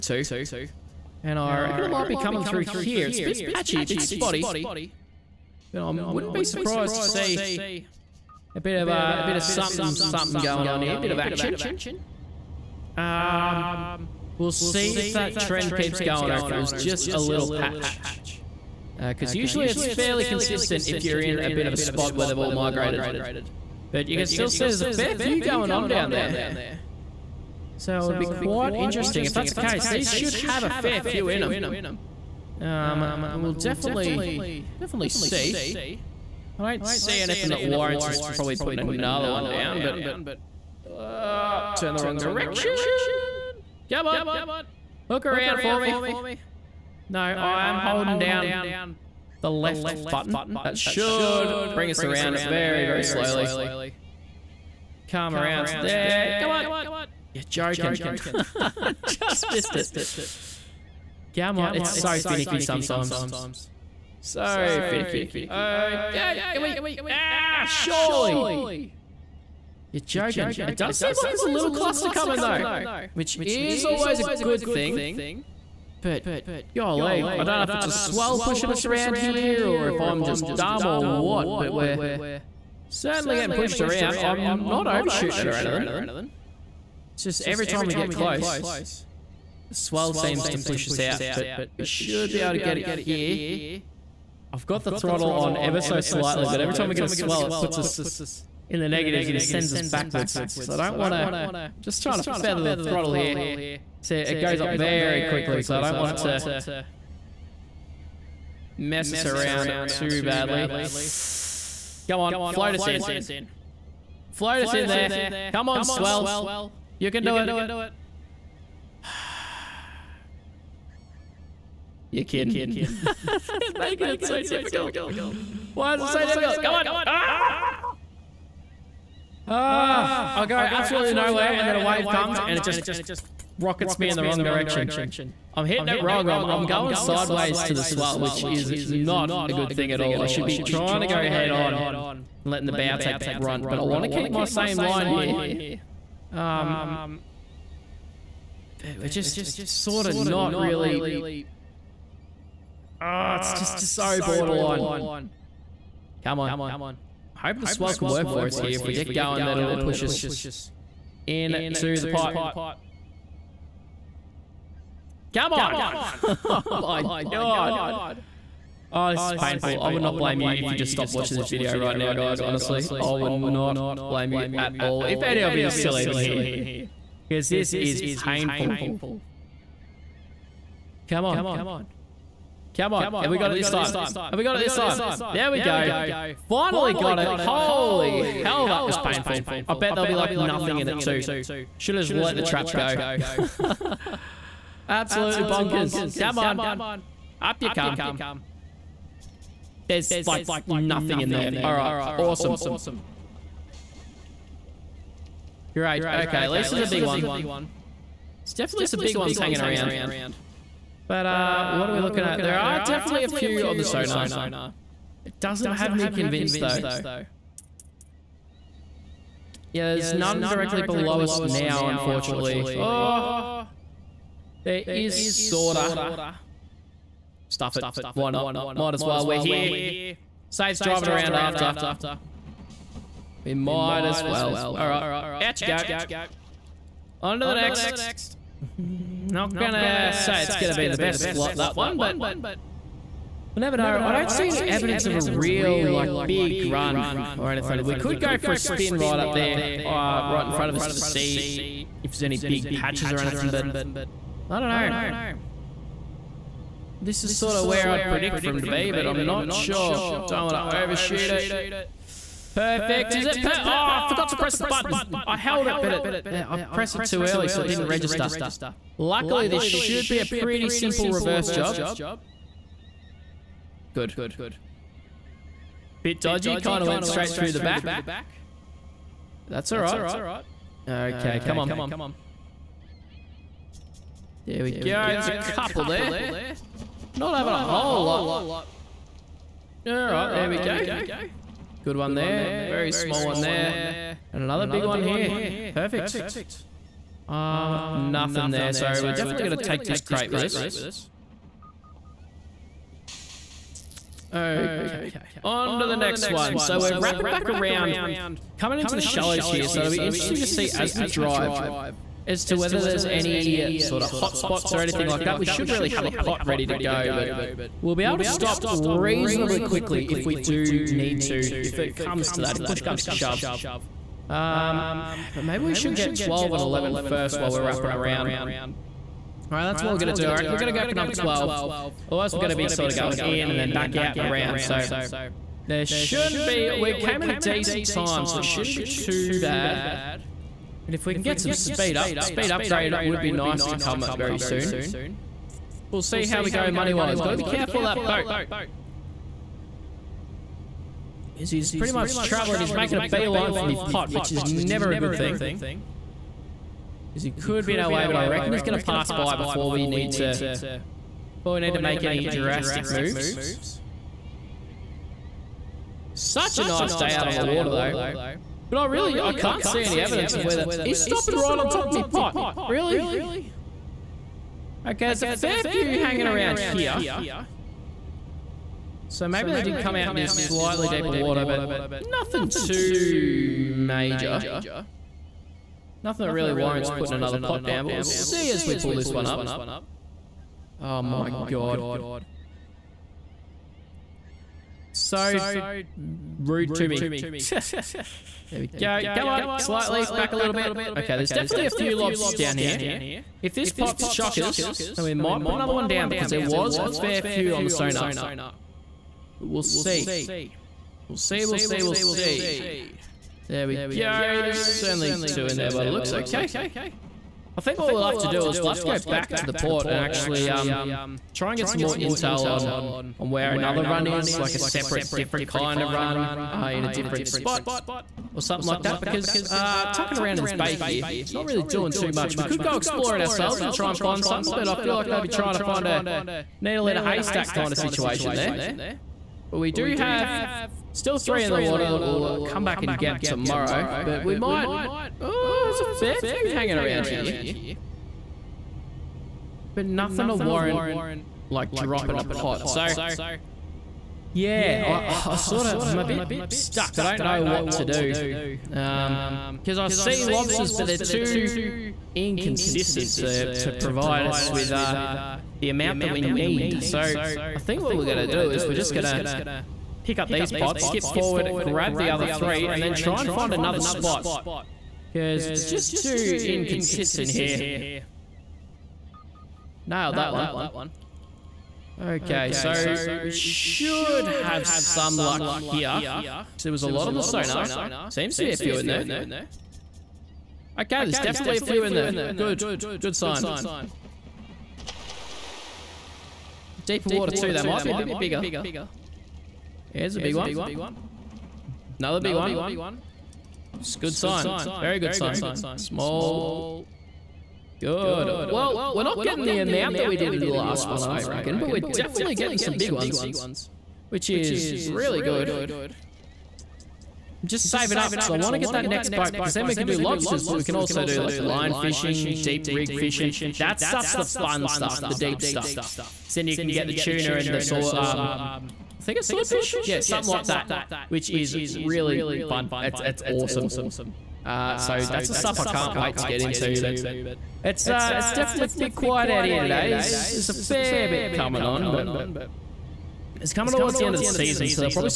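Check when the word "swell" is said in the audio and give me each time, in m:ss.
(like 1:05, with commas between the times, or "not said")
1:17, 1:29, 1:37, 1:55, 2:17, 2:37.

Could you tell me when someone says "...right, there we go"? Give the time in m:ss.
4:49.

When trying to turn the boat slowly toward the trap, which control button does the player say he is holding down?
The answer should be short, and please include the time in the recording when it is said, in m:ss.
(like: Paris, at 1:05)
Left button, at 0:49.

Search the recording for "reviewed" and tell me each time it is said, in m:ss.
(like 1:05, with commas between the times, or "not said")
not said.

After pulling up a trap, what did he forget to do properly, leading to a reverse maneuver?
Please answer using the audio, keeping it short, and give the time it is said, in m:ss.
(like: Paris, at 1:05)
Press the button, at 4:24.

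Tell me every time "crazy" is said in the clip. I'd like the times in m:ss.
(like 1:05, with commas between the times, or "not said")
not said.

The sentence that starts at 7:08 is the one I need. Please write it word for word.
Because uh, tucking around in this bay here, it's not really doing too much.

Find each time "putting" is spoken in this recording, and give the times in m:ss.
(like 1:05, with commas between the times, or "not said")
0:38, 6:26.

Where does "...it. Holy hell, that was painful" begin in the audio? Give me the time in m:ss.
3:07.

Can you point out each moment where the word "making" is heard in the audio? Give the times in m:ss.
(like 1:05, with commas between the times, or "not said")
2:03, 5:52.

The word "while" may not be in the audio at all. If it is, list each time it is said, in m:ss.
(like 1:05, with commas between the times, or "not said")
5:27.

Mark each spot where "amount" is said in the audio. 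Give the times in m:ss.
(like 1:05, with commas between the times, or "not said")
7:45, 8:29.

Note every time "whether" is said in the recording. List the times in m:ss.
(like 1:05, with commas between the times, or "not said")
5:12, 6:10.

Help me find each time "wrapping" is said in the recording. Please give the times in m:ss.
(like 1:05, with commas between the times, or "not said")
5:06, 5:27.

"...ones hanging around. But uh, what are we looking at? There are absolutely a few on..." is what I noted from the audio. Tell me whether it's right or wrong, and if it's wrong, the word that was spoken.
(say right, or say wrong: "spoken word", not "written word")
wrong: "definitely", not "absolutely".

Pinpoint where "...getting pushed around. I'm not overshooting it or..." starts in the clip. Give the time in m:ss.
1:23.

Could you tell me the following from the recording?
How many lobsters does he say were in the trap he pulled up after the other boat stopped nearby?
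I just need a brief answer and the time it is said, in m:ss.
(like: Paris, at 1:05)
2, at 6:55.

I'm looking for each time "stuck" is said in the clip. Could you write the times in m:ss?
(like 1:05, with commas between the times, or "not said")
7:36.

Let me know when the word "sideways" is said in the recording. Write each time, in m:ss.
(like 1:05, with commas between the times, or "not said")
2:16.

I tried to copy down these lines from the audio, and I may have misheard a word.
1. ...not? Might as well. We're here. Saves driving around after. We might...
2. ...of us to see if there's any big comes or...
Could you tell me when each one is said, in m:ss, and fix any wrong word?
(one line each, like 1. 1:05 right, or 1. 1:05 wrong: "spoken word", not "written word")
1. 3:48 right
2. 4:10 wrong: "patches", not "comes".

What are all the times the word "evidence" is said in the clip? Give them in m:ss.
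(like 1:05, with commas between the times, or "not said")
4:04, 6:09.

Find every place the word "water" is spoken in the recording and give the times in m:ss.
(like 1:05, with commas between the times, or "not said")
6:07, 6:21, 7:21, 8:17.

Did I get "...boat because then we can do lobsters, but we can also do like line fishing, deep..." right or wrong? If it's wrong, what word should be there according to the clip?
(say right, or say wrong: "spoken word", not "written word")
right.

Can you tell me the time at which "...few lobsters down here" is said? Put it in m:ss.
6:41.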